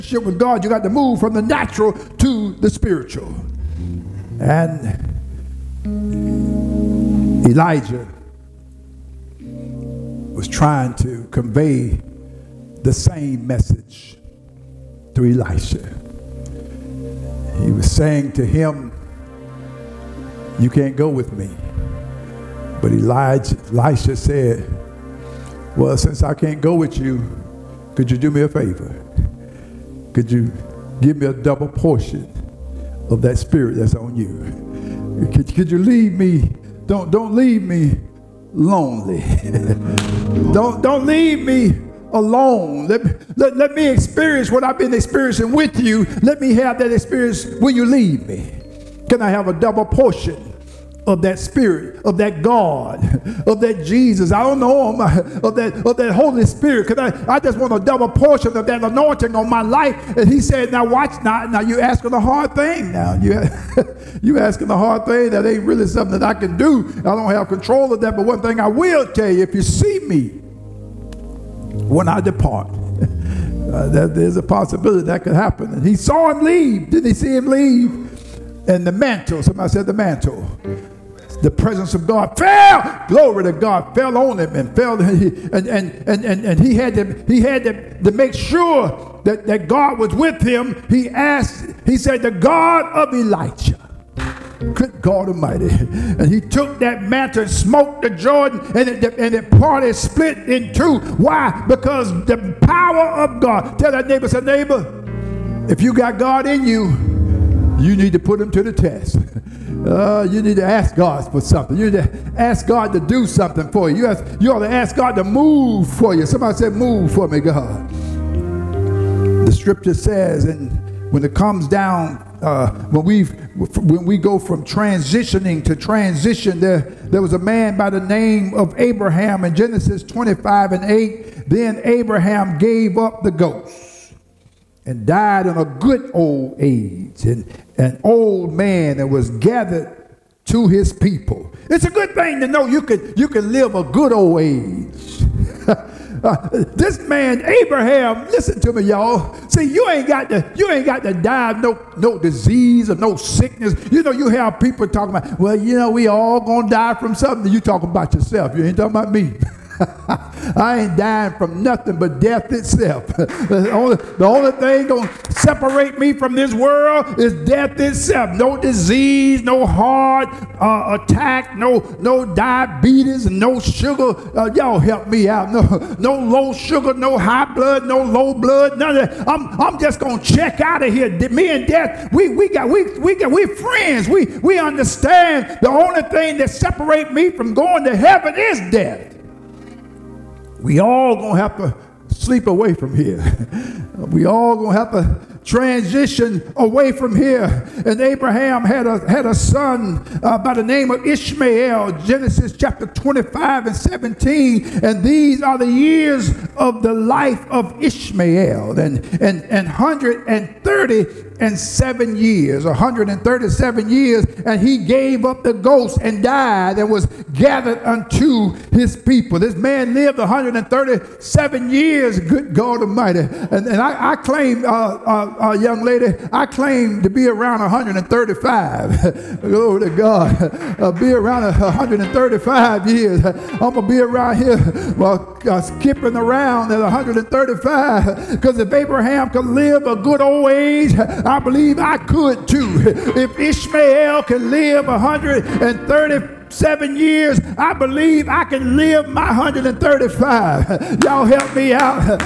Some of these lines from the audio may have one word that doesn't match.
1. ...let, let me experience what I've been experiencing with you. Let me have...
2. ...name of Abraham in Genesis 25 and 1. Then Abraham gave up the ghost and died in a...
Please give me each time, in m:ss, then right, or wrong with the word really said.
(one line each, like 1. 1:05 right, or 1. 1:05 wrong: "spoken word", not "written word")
1. 0:43 right
2. 2:08 wrong: "8", not "1".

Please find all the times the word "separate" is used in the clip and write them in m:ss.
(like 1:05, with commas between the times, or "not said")
2:45, 3:06.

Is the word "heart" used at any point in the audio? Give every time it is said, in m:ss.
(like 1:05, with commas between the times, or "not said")
2:49.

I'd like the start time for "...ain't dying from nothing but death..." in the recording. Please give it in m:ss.
2:40.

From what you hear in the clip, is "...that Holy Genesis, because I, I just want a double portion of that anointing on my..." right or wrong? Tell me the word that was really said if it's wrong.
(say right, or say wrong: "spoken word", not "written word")
wrong: "Spirit", not "Genesis".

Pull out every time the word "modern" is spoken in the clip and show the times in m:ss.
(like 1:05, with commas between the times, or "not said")
not said.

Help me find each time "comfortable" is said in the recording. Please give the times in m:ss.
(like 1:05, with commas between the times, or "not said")
not said.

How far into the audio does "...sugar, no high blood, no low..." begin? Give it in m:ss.
2:56.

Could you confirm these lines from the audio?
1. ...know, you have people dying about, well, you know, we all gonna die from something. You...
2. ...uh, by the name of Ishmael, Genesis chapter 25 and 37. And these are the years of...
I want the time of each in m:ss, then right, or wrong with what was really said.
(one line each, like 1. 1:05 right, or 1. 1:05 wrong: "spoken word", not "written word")
1. 2:34 wrong: "talking", not "dying"
2. 3:20 wrong: "17", not "37".